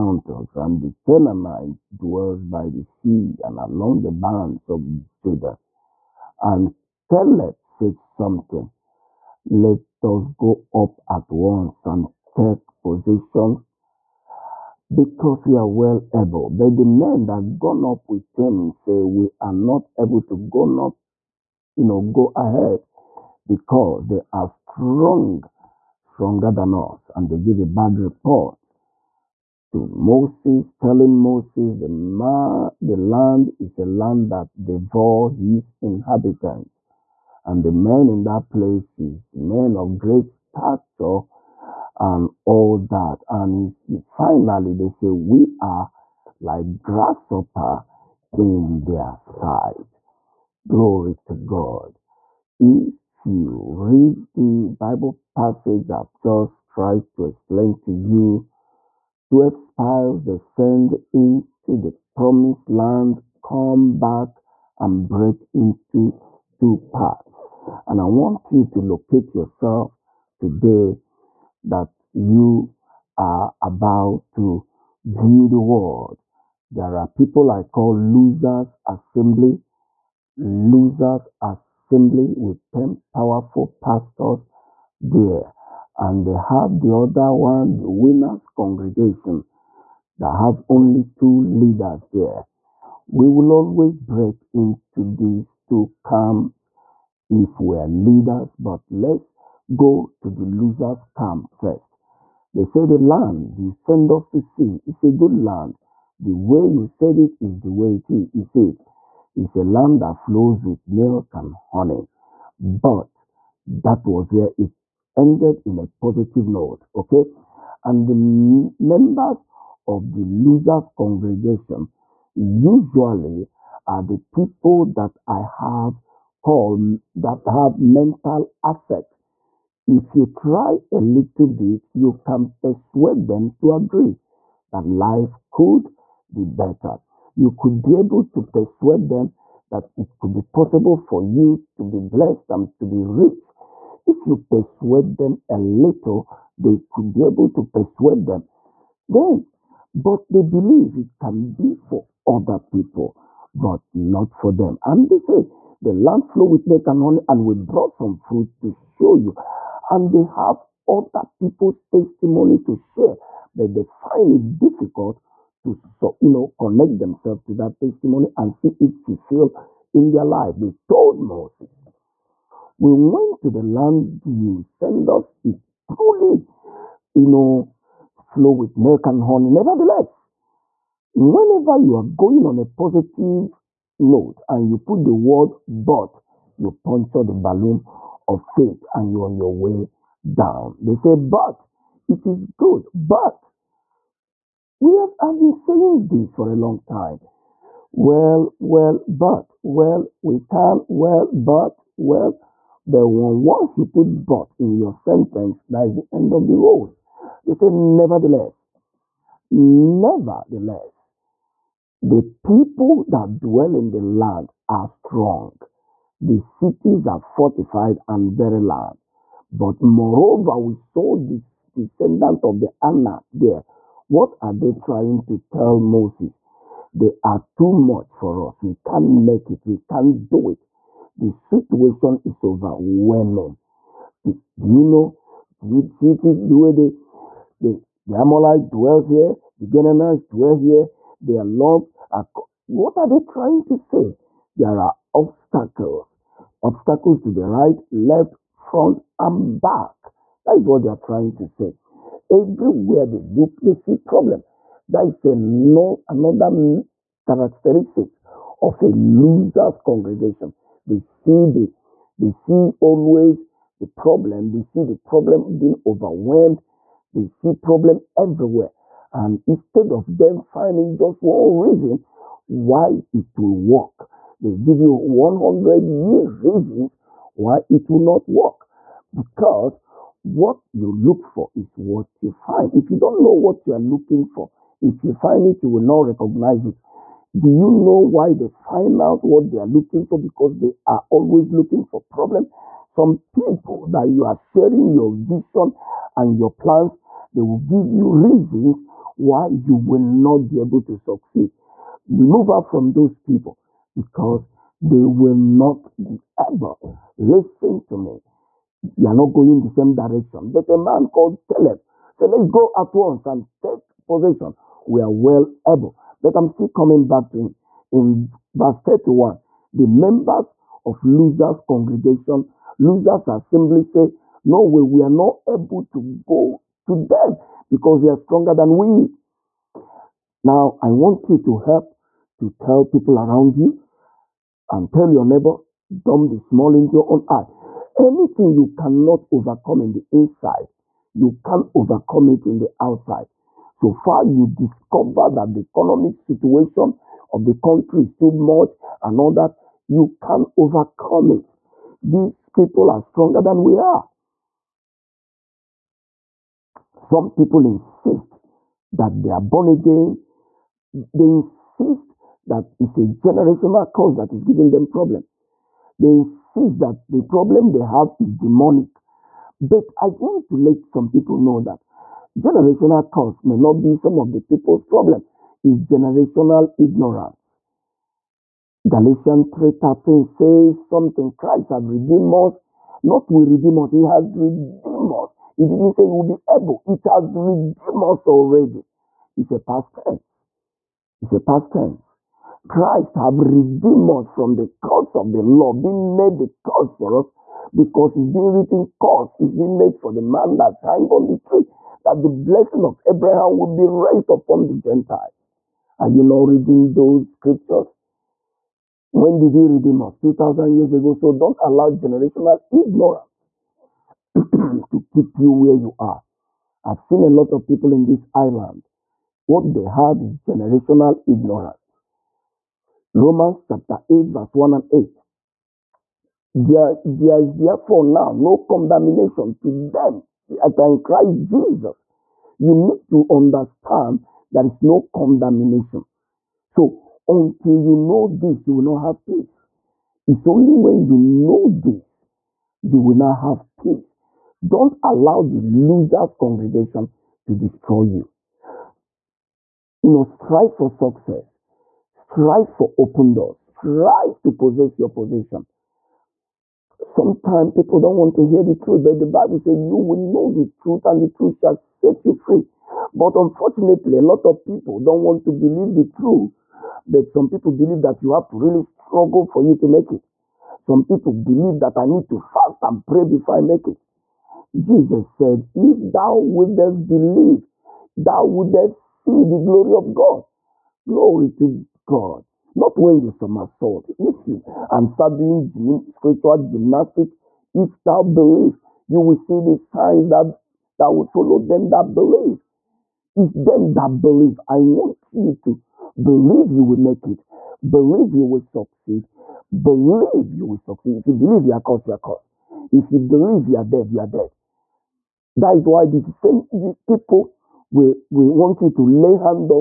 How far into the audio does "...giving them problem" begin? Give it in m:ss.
6:04.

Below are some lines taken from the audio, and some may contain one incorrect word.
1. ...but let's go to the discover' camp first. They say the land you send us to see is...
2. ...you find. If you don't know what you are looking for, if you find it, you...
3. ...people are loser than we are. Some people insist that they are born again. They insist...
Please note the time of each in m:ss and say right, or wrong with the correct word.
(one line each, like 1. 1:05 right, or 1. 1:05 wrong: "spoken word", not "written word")
1. 1:38 wrong: "losers", not "discover"
2. 4:42 right
3. 5:52 wrong: "stronger", not "loser".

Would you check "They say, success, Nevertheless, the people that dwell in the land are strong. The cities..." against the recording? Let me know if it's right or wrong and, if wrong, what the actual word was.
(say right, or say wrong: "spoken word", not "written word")
wrong: "nevertheless", not "success".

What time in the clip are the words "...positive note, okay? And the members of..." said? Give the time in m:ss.
1:56.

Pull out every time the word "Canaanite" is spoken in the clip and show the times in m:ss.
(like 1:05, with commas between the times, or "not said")
0:01, 3:59.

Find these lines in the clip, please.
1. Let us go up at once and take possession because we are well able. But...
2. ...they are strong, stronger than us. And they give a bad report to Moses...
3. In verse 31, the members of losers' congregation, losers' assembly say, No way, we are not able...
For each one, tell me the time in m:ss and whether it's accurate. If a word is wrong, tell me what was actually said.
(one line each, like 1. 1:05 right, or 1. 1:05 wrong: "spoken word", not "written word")
1. 0:09 right
2. 0:24 right
3. 5:17 right.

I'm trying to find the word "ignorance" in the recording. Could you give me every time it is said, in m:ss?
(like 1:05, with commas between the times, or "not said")
6:16, 6:52, 7:01.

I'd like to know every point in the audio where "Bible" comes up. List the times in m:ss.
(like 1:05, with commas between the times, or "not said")
0:54, 7:39.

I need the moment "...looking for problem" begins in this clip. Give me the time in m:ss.
4:51.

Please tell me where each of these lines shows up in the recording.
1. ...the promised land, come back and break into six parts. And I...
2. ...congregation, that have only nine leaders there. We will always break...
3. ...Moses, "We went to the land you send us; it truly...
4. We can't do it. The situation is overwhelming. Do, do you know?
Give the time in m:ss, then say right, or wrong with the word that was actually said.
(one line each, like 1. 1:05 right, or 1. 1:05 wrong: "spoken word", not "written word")
1. 1:01 wrong: "two", not "six"
2. 1:28 wrong: "two", not "nine"
3. 2:51 right
4. 3:49 right.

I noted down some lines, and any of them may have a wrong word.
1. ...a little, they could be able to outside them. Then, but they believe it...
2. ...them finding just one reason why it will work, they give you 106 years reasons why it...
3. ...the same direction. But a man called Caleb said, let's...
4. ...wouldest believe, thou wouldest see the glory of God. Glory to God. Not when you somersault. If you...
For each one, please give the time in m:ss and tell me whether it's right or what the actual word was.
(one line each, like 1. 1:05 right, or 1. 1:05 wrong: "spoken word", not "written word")
1. 2:25 wrong: "persuade", not "outside"
2. 4:30 wrong: "100", not "106"
3. 5:09 right
4. 7:56 right.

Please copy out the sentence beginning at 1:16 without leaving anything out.
There are people I call losers assembly, losers assembly with 10 powerful pastors there.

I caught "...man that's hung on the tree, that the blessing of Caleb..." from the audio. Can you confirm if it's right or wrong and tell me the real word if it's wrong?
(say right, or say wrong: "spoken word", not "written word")
wrong: "Abraham", not "Caleb".